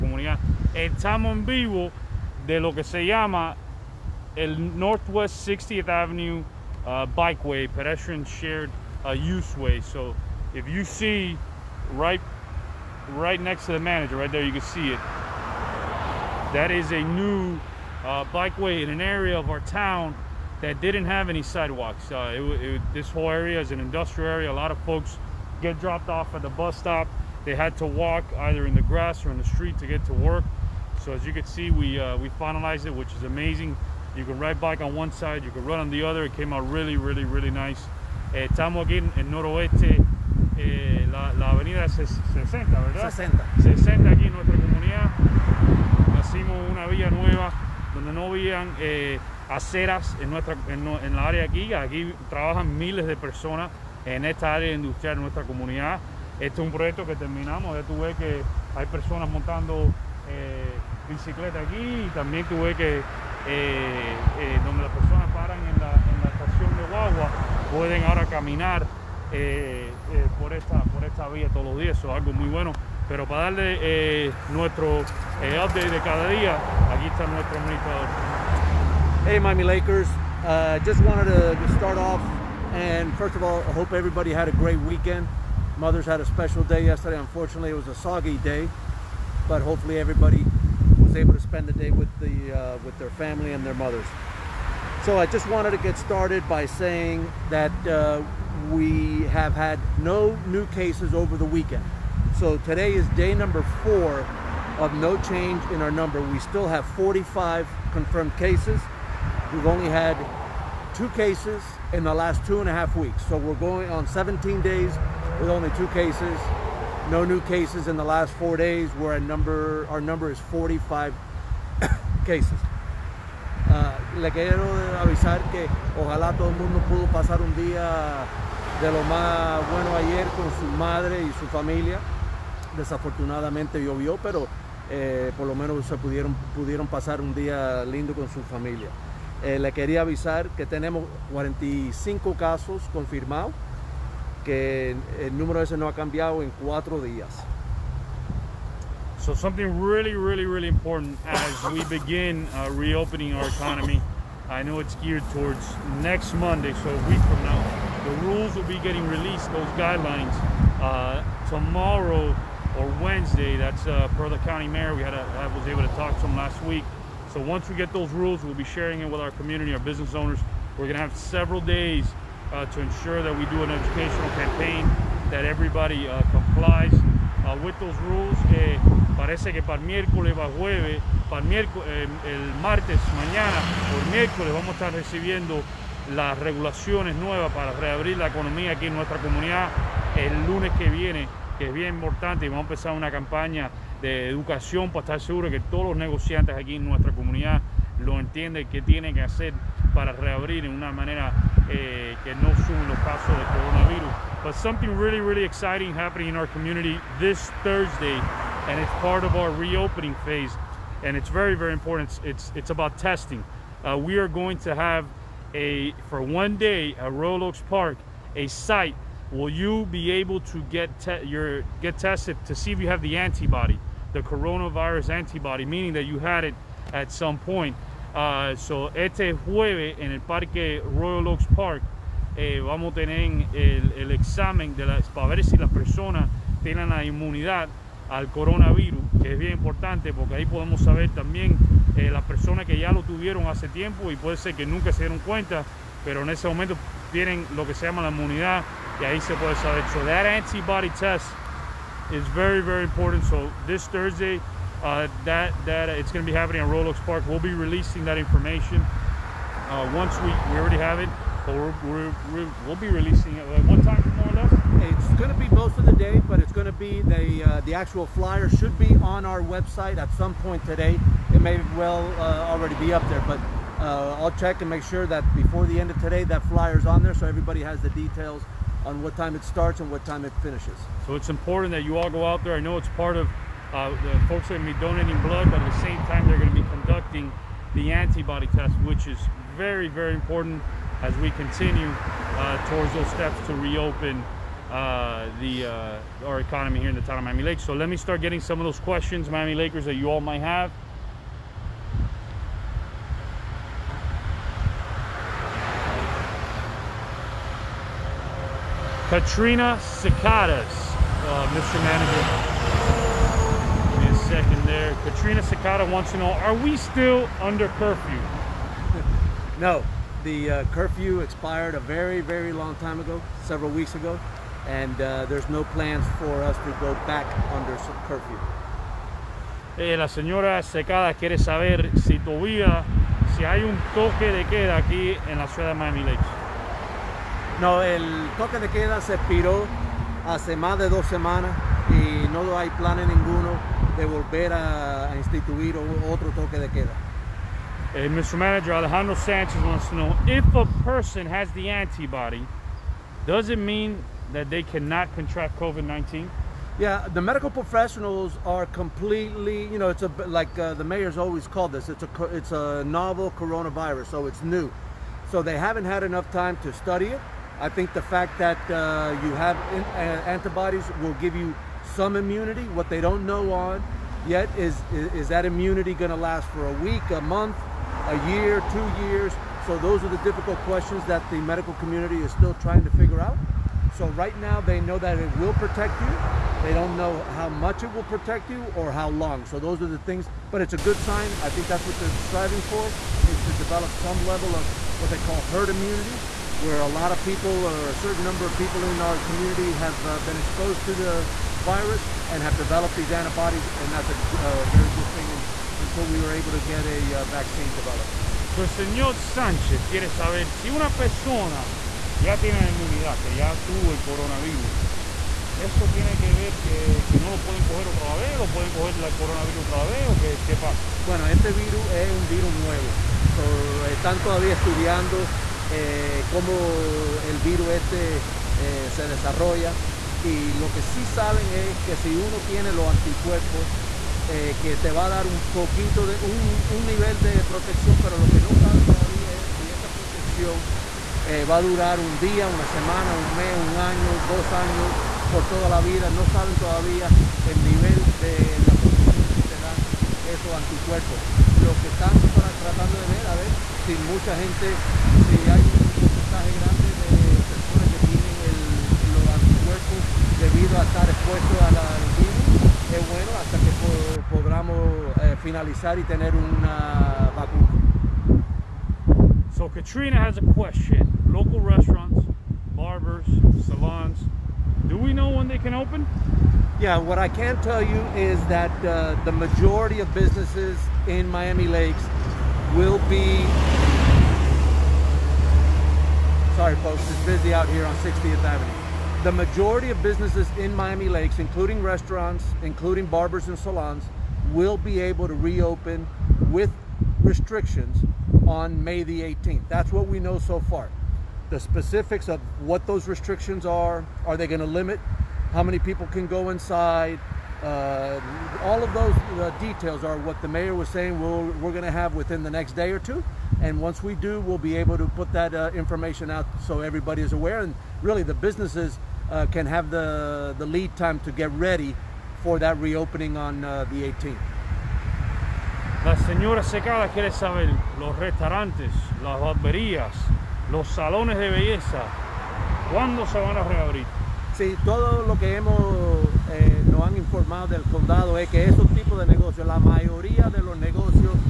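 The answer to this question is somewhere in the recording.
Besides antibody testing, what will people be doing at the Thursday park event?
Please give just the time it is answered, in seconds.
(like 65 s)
284 s.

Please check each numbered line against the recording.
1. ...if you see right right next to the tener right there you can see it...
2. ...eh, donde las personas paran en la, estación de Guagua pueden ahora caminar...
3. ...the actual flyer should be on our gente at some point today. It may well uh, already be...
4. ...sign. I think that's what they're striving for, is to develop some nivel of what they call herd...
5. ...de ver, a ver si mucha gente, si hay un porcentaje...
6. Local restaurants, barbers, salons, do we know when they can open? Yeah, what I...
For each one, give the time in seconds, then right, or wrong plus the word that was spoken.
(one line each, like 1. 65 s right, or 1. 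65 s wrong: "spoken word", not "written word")
1. 10 s wrong: "manager", not "tener"
2. 63 s right
3. 267 s wrong: "website", not "gente"
4. 391 s wrong: "level", not "nivel"
5. 452 s right
6. 471 s right.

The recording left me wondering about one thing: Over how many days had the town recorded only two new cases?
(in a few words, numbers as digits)
17.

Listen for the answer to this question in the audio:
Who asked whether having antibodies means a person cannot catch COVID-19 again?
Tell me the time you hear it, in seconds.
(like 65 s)
348 s.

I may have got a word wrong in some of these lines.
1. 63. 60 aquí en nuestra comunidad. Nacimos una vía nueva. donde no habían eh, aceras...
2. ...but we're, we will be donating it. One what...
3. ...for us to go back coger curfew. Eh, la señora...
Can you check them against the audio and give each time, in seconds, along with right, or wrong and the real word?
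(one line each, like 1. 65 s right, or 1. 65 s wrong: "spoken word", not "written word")
1. 43 s wrong: "60", not "63"
2. 261 s wrong: "releasing", not "donating"
3. 326 s wrong: "under", not "coger".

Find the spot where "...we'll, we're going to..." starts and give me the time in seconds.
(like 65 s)
511 s.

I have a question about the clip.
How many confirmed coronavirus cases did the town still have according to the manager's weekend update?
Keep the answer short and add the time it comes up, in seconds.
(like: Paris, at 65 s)
45, at 106 s.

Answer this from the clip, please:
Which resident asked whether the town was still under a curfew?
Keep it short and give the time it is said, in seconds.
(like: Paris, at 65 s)
Katrina Secada, at 315 s.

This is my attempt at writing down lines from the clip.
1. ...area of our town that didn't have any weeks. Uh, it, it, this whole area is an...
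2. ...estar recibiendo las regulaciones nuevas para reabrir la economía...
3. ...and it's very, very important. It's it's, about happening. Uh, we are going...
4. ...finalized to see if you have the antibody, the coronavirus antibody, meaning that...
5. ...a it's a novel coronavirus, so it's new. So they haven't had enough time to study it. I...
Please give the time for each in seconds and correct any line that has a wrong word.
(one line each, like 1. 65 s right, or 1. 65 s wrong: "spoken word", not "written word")
1. 19 s wrong: "sidewalks", not "weeks"
2. 184 s right
3. 211 s wrong: "testing", not "happening"
4. 221 s wrong: "tested", not "finalized"
5. 362 s right.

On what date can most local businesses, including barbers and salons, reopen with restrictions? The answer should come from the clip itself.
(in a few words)
May 18.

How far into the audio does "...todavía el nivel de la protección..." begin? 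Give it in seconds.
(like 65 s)
446 s.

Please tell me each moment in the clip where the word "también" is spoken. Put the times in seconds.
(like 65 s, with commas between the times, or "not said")
62 s, 241 s.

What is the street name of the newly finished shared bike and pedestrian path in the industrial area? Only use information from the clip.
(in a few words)
Northwest 60th Avenue.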